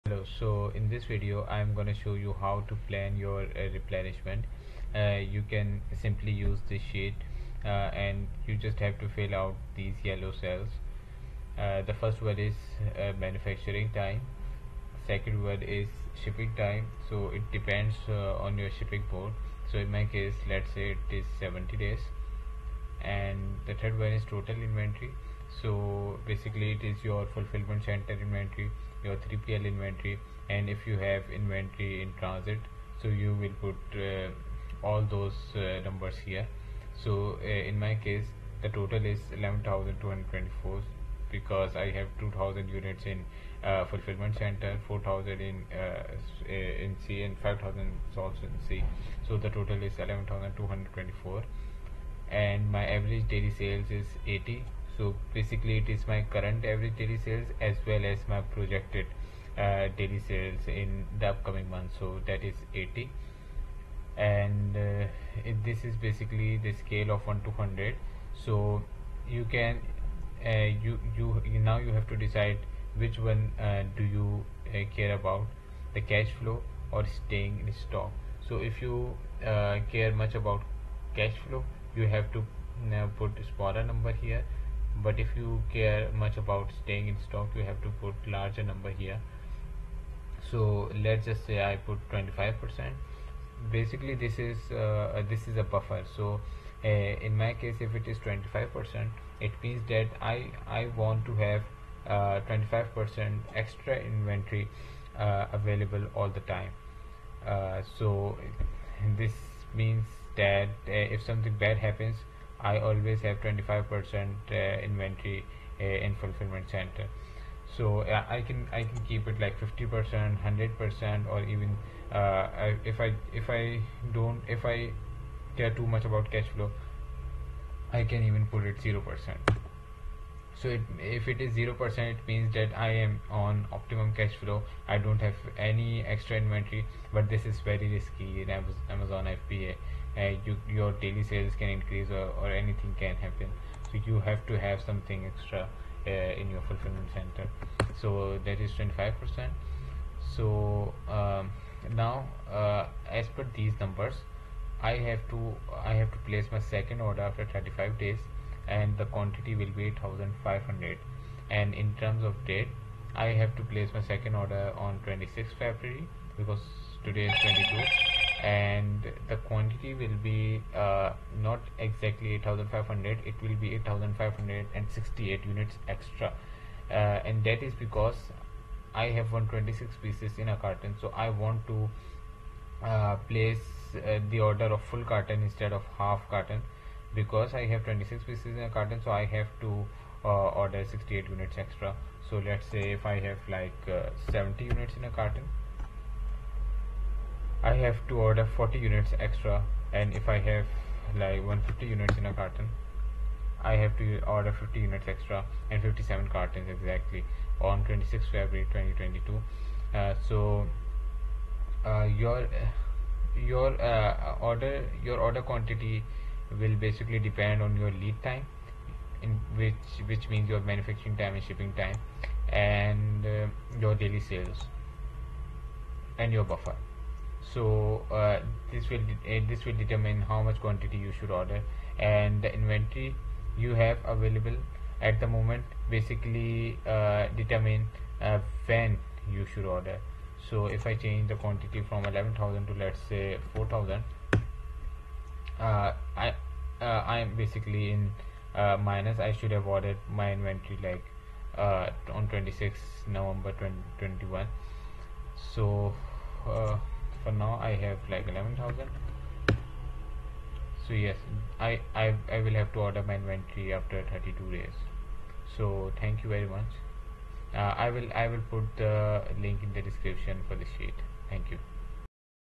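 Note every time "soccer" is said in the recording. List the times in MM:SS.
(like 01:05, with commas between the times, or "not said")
not said.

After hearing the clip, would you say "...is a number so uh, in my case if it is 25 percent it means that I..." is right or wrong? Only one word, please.
wrong.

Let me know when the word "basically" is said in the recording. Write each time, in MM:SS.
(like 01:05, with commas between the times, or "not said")
00:26, 00:55, 01:05, 01:33, 03:36, 03:55, 04:07.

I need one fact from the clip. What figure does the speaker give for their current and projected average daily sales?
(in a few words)
80.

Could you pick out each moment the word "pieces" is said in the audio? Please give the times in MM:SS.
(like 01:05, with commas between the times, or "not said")
03:00, 03:08.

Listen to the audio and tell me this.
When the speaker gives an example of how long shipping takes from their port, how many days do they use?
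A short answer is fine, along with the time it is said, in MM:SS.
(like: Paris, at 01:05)
70 days, at 00:21.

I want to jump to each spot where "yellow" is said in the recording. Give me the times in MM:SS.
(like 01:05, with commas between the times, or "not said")
00:10.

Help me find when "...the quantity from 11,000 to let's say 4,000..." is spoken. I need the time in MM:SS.
04:01.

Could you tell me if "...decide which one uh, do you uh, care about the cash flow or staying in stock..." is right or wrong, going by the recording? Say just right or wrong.
right.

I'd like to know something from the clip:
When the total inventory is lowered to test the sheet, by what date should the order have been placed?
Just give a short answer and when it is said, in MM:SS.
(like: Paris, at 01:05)
26 November 2021, at 04:12.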